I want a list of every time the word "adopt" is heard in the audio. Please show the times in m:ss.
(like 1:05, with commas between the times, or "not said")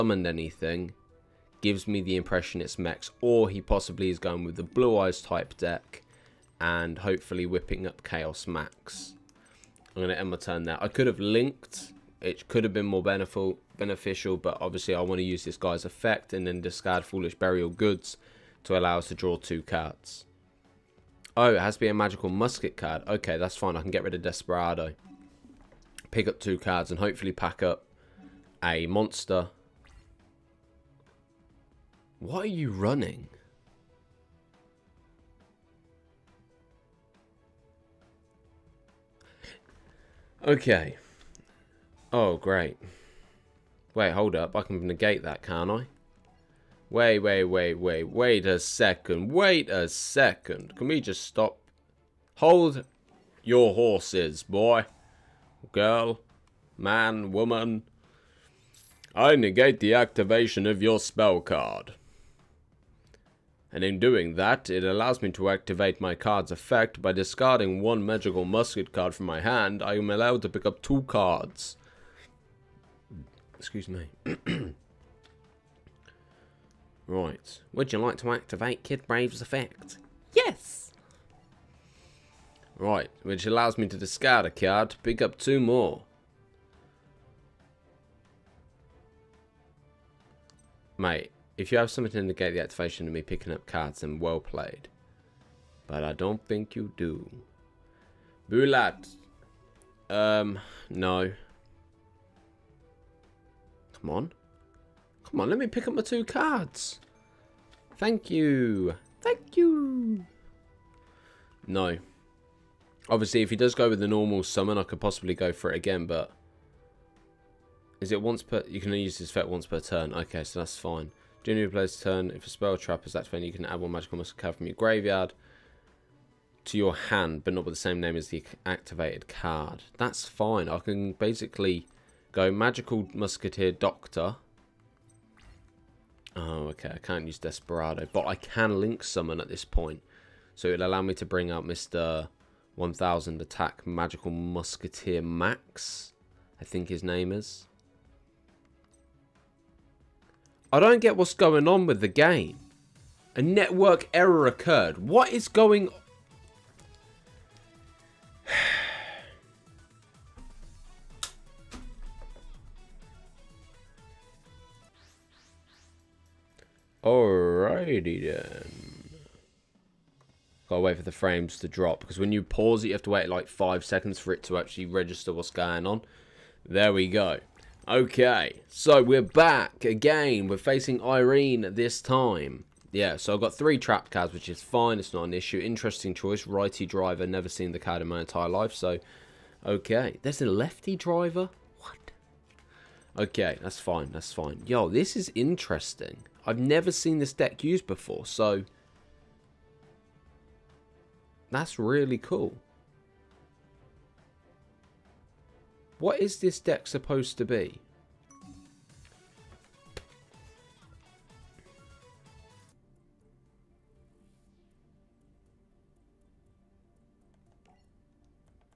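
not said.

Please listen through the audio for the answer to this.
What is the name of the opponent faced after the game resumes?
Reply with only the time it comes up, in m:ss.
3:01.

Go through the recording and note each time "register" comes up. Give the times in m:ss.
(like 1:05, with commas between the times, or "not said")
2:54.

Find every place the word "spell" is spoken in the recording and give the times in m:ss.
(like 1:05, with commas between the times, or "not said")
1:00, 2:02.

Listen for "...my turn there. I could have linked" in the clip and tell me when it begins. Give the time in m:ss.
0:10.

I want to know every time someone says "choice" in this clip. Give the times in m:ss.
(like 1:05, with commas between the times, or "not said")
3:06.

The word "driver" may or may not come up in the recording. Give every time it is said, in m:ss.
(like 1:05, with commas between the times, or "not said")
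3:06, 3:10.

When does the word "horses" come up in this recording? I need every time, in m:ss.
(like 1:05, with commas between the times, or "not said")
0:53.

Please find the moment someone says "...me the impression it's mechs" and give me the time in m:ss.
0:01.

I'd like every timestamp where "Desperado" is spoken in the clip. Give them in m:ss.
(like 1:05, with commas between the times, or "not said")
0:24, 2:17.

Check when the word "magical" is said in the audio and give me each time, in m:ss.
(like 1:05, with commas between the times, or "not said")
0:21, 1:08, 2:03, 2:12, 2:23.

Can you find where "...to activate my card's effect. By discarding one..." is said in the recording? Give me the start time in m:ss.
1:05.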